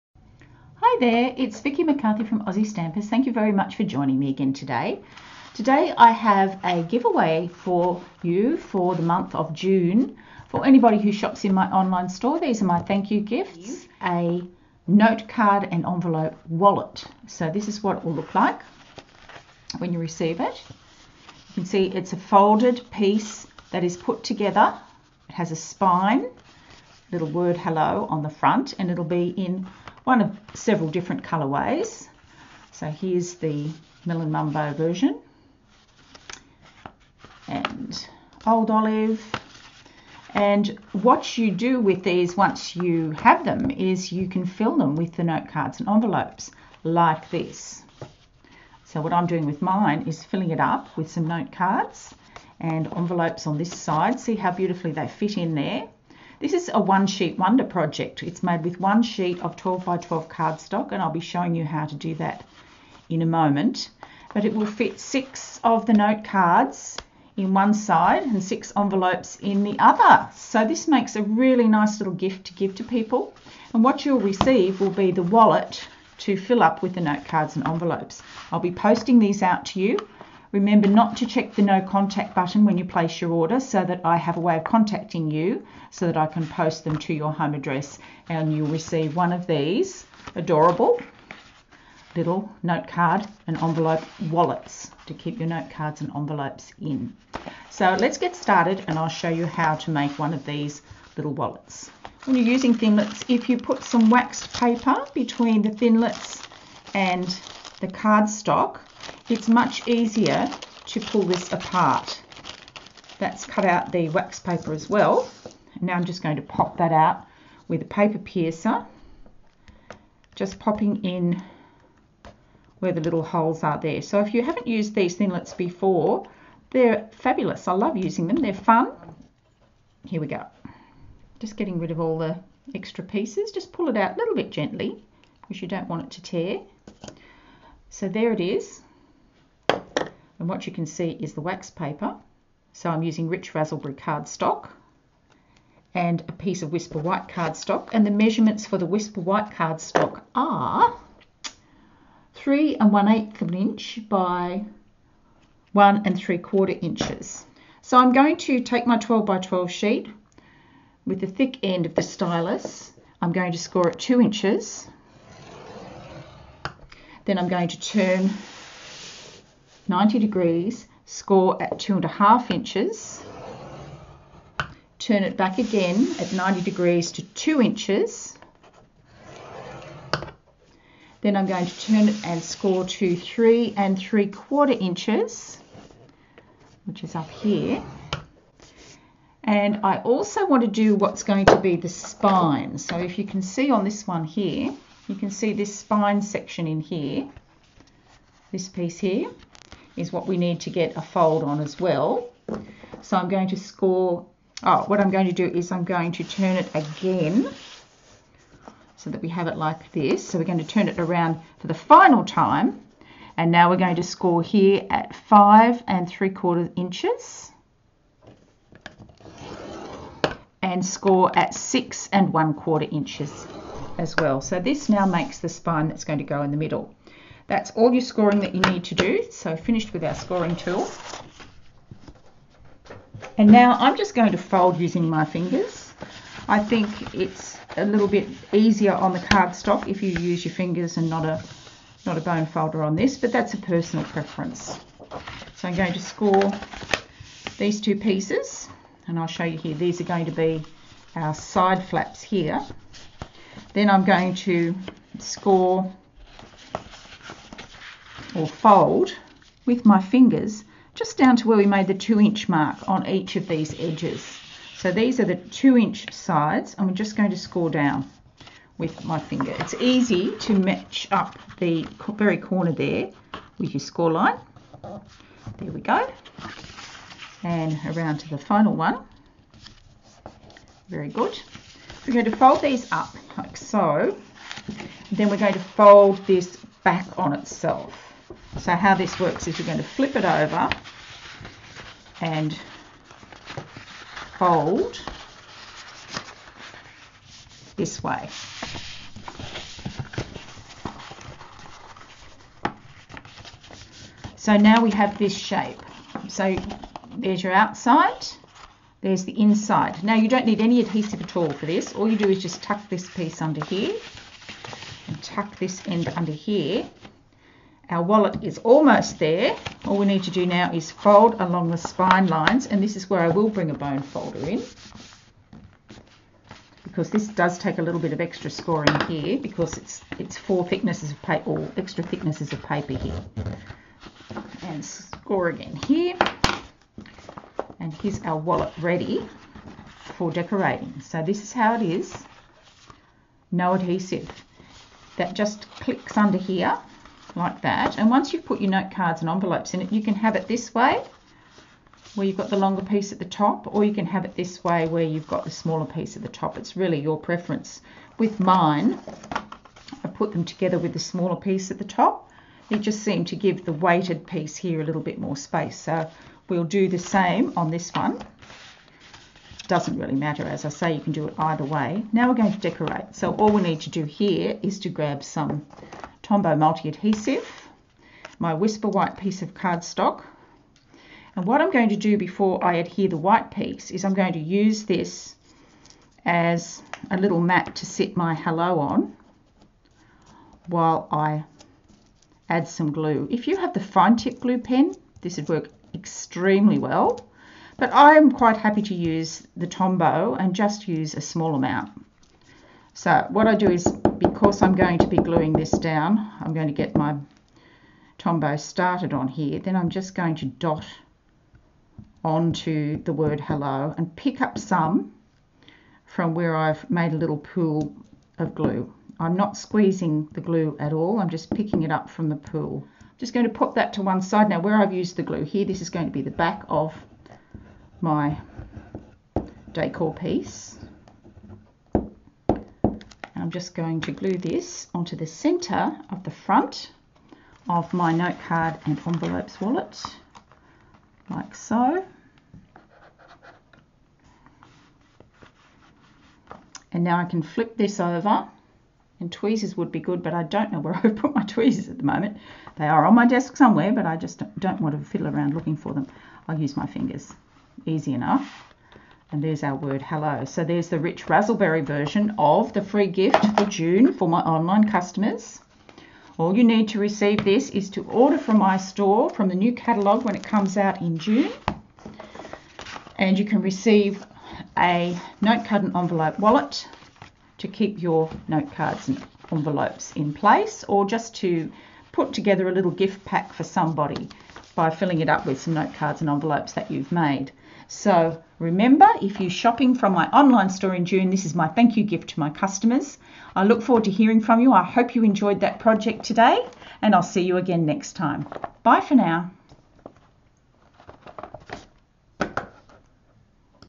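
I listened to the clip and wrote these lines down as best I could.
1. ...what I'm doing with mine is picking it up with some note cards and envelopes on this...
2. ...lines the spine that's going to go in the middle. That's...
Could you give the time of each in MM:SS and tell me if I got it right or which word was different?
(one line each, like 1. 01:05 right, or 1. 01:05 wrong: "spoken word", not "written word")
1. 00:48 wrong: "filling", not "picking"
2. 03:45 wrong: "makes", not "lines".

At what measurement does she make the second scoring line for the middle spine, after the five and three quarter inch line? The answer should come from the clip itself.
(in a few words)
6 1/4 inches.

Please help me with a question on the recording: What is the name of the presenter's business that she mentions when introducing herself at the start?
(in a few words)
Aussie Stampers.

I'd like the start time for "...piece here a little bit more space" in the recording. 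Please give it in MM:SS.
06:04.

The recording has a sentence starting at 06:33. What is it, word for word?
If you have the fine tip glue pen, this would work extremely well.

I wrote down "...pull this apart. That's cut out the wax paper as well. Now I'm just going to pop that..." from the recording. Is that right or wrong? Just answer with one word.
right.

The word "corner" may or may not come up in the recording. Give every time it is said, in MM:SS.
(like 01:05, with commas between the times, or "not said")
04:32.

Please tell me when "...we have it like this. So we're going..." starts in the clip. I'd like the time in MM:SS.
03:29.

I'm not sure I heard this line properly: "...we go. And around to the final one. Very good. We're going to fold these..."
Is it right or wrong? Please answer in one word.
right.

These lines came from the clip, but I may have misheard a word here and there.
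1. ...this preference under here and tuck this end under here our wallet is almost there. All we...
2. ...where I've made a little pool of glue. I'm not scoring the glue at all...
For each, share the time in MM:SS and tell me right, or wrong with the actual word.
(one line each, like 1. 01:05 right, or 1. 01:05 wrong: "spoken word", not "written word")
1. 05:12 wrong: "piece", not "preference"
2. 06:56 wrong: "squeezing", not "scoring".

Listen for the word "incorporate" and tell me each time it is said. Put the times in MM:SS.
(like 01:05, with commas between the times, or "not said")
not said.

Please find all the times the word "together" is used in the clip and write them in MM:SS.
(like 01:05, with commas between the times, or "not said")
00:24, 06:00, 08:02.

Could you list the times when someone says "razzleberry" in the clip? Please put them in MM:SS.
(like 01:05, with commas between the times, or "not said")
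02:23, 07:41.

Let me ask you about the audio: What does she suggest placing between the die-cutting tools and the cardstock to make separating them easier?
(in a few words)
Waxed paper.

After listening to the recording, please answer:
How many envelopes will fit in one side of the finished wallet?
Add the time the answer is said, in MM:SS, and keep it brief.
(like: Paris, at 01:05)
6, at 01:08.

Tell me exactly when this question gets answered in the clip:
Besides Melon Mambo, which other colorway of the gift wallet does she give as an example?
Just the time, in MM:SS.
00:38.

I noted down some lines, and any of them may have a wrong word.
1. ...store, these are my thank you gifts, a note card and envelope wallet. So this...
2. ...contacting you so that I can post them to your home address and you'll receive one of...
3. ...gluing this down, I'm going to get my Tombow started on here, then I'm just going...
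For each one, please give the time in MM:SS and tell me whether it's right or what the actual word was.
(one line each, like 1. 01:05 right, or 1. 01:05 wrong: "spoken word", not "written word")
1. 00:12 right
2. 01:24 right
3. 06:45 right.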